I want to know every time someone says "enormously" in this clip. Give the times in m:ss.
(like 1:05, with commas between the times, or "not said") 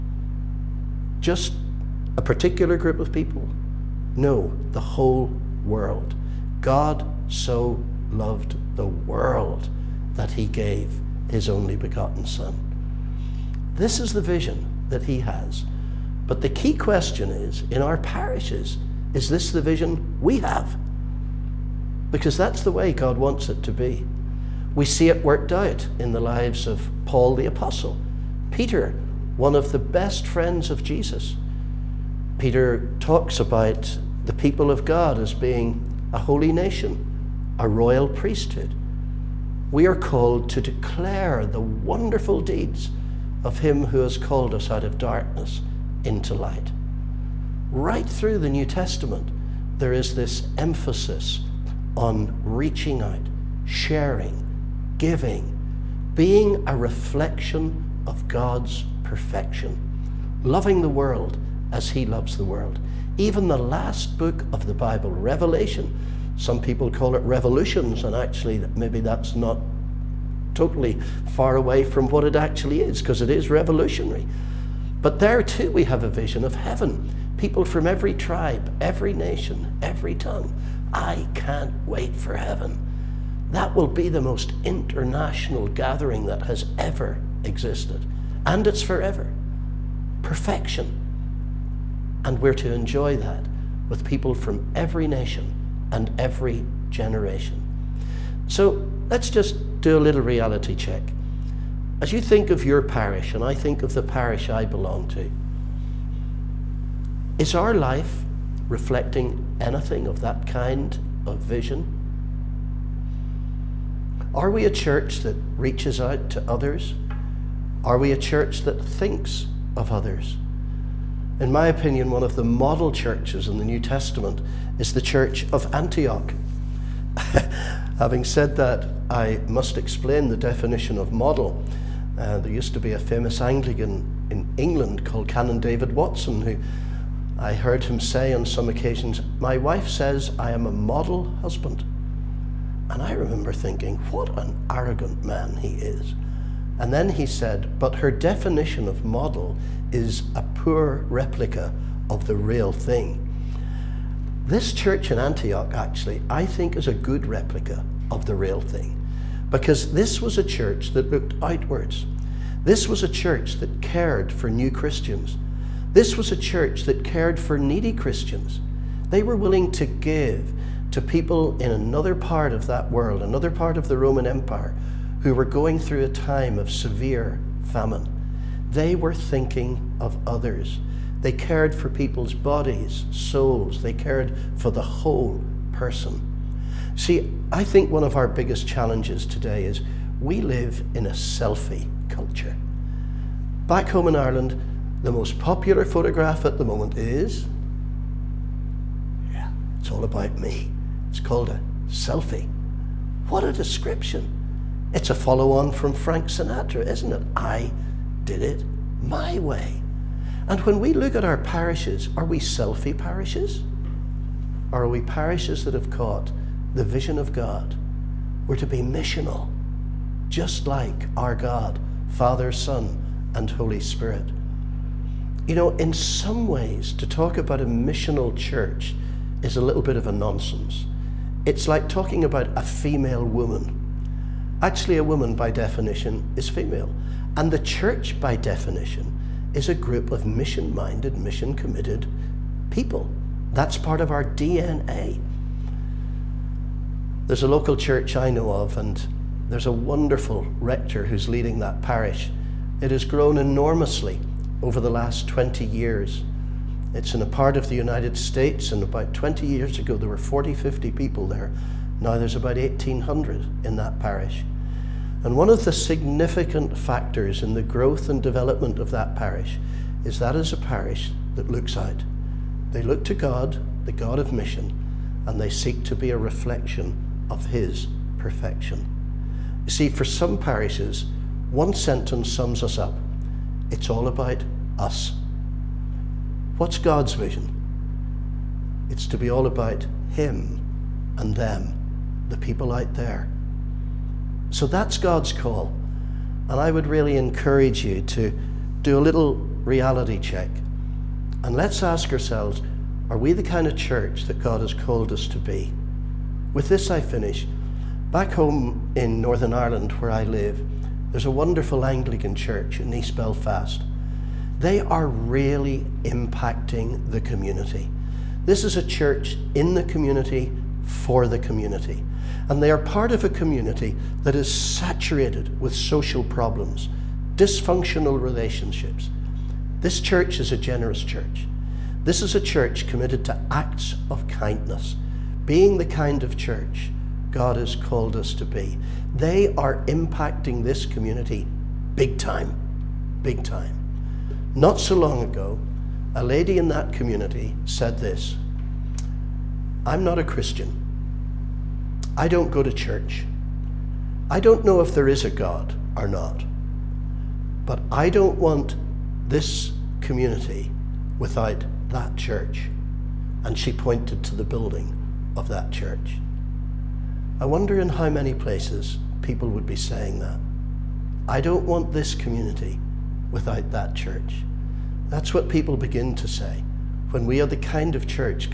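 4:13.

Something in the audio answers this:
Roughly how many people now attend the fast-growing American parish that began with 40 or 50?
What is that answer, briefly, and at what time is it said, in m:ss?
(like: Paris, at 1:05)
1,800, at 4:22.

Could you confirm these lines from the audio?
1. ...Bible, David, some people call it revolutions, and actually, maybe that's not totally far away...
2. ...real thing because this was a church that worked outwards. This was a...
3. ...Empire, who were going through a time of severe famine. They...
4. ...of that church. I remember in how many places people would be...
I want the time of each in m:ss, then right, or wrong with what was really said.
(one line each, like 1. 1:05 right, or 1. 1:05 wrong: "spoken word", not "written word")
1. 1:04 wrong: "Revelation", not "David"
2. 2:38 wrong: "looked", not "worked"
3. 2:54 right
4. 6:05 wrong: "wonder", not "remember".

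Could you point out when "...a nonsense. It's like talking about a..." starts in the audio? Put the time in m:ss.
3:50.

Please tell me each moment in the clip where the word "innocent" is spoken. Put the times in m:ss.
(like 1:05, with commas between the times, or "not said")
not said.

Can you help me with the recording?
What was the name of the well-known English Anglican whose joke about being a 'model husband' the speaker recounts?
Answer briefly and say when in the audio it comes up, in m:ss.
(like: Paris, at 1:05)
Canon David Watson, at 2:15.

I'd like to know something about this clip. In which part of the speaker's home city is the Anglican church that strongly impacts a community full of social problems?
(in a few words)
East Belfast.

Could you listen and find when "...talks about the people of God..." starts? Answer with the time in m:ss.
0:32.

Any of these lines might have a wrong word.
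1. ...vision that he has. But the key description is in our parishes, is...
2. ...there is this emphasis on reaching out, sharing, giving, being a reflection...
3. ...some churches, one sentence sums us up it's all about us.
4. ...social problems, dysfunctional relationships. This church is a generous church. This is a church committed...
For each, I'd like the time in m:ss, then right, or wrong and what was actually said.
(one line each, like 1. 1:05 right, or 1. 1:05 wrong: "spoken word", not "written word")
1. 0:14 wrong: "question", not "description"
2. 0:49 right
3. 4:40 wrong: "parishes", not "churches"
4. 5:25 right.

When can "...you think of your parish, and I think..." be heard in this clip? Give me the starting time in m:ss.
1:42.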